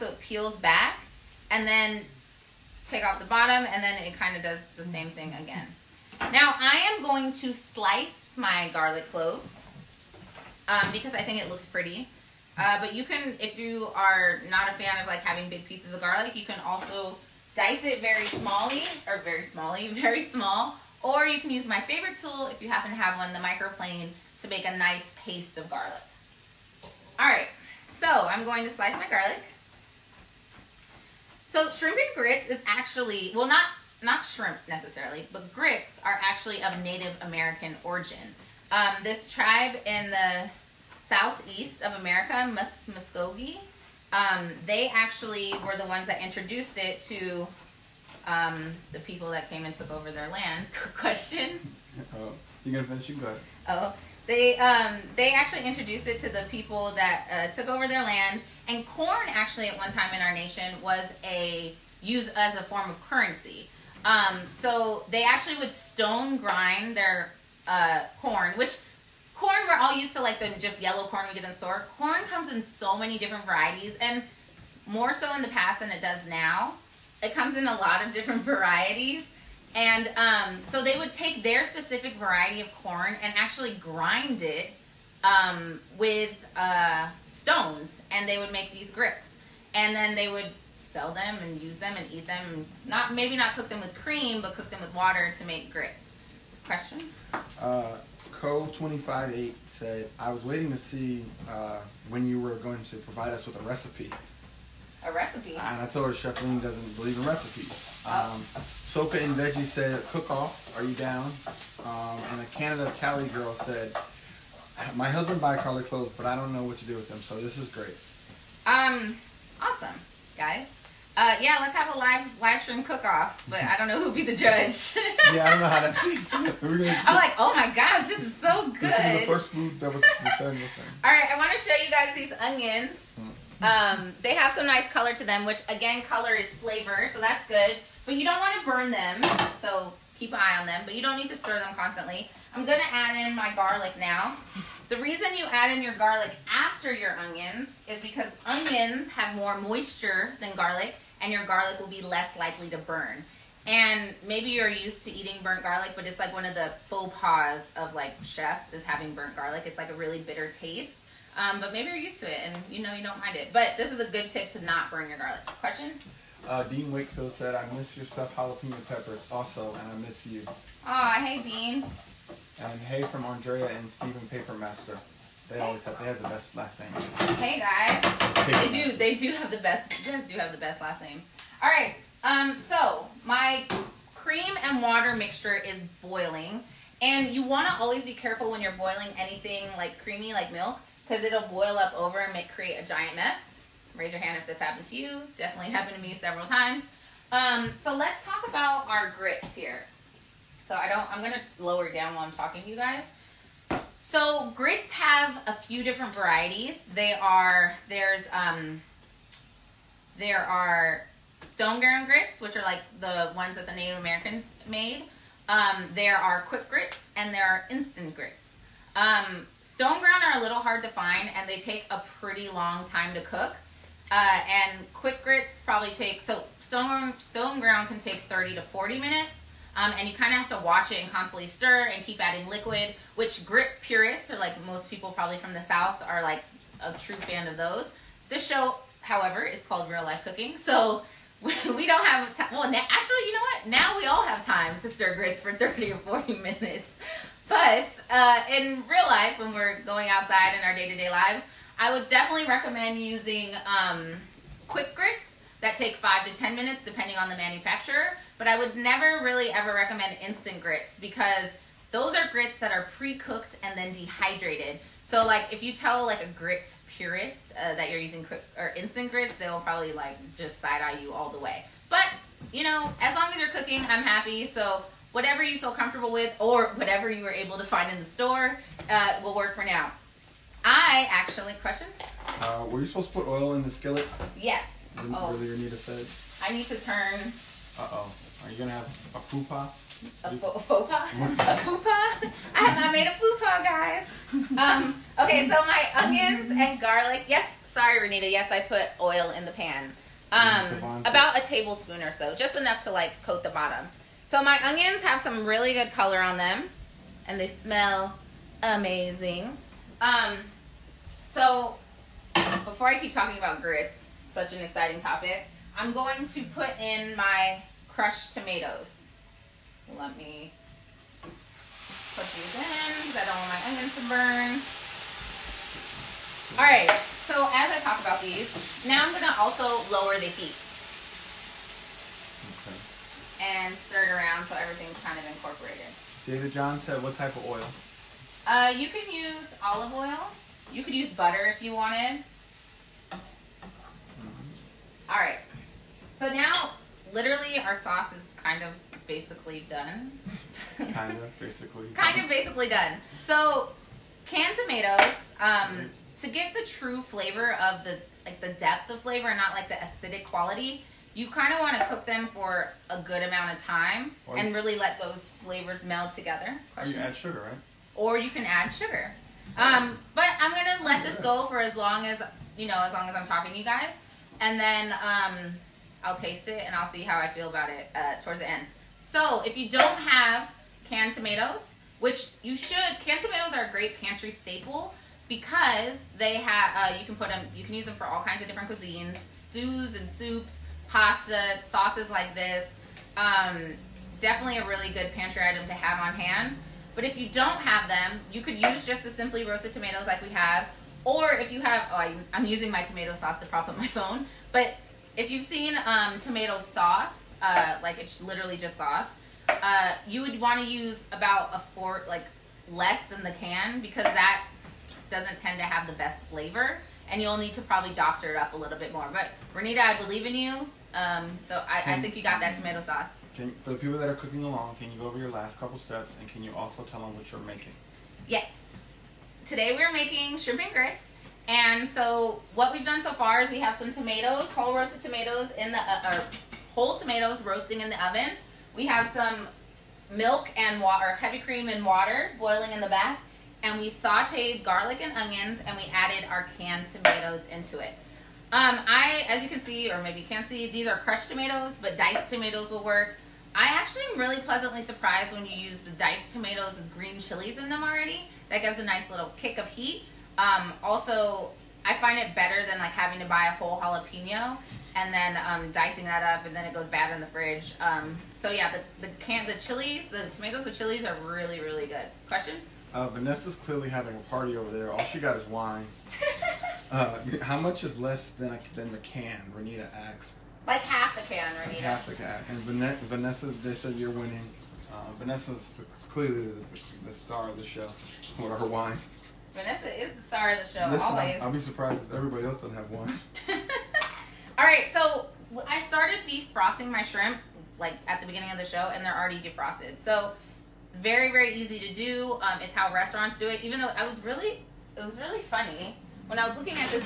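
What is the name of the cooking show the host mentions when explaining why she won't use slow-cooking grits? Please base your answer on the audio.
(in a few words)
Real Life Cooking.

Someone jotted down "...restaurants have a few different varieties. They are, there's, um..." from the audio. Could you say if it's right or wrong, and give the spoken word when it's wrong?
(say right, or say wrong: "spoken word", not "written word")
wrong: "grits", not "restaurants".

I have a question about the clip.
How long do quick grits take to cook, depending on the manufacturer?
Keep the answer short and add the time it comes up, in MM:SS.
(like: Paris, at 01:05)
5 to 10 minutes, at 04:15.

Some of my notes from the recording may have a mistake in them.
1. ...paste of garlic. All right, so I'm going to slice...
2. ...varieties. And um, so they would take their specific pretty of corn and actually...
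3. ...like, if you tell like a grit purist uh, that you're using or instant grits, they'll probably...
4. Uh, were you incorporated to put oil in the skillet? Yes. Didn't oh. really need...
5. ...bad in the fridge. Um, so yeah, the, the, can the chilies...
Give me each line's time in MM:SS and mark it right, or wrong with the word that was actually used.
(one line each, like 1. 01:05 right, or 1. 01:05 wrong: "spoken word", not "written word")
1. 00:25 right
2. 01:18 wrong: "variety", not "pretty"
3. 04:25 right
4. 04:42 wrong: "supposed", not "incorporated"
5. 07:46 right.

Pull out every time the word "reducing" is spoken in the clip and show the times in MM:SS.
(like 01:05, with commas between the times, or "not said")
not said.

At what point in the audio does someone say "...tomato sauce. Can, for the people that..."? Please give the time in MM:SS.
07:02.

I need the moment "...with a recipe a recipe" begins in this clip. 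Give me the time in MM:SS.
01:43.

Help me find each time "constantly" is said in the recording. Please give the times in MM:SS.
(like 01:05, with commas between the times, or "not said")
02:21, 03:51.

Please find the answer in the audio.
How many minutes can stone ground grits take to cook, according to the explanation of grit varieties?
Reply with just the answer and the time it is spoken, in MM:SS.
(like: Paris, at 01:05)
30 to 40 minutes, at 03:48.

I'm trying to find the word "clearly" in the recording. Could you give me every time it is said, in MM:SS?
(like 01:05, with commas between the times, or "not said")
07:53, 08:06.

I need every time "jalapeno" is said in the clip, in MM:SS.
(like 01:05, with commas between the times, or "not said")
02:48, 07:43.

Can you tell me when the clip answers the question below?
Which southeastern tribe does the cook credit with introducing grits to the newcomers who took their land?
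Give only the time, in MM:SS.
00:42.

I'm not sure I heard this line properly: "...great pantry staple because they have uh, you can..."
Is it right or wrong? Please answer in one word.
right.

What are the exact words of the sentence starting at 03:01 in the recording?
All right, um, so my cream and water mixture is boiling.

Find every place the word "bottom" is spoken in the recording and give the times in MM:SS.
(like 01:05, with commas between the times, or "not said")
00:03, 05:03.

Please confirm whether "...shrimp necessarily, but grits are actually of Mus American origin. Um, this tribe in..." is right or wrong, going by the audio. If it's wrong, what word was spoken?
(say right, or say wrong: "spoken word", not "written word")
wrong: "Native", not "Mus".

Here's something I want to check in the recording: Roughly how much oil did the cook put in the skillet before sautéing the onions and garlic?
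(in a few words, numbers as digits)
about a tablespoon.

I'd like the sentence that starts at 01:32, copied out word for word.
Not Maybe not cook them with cream, but cook them with water to make grits.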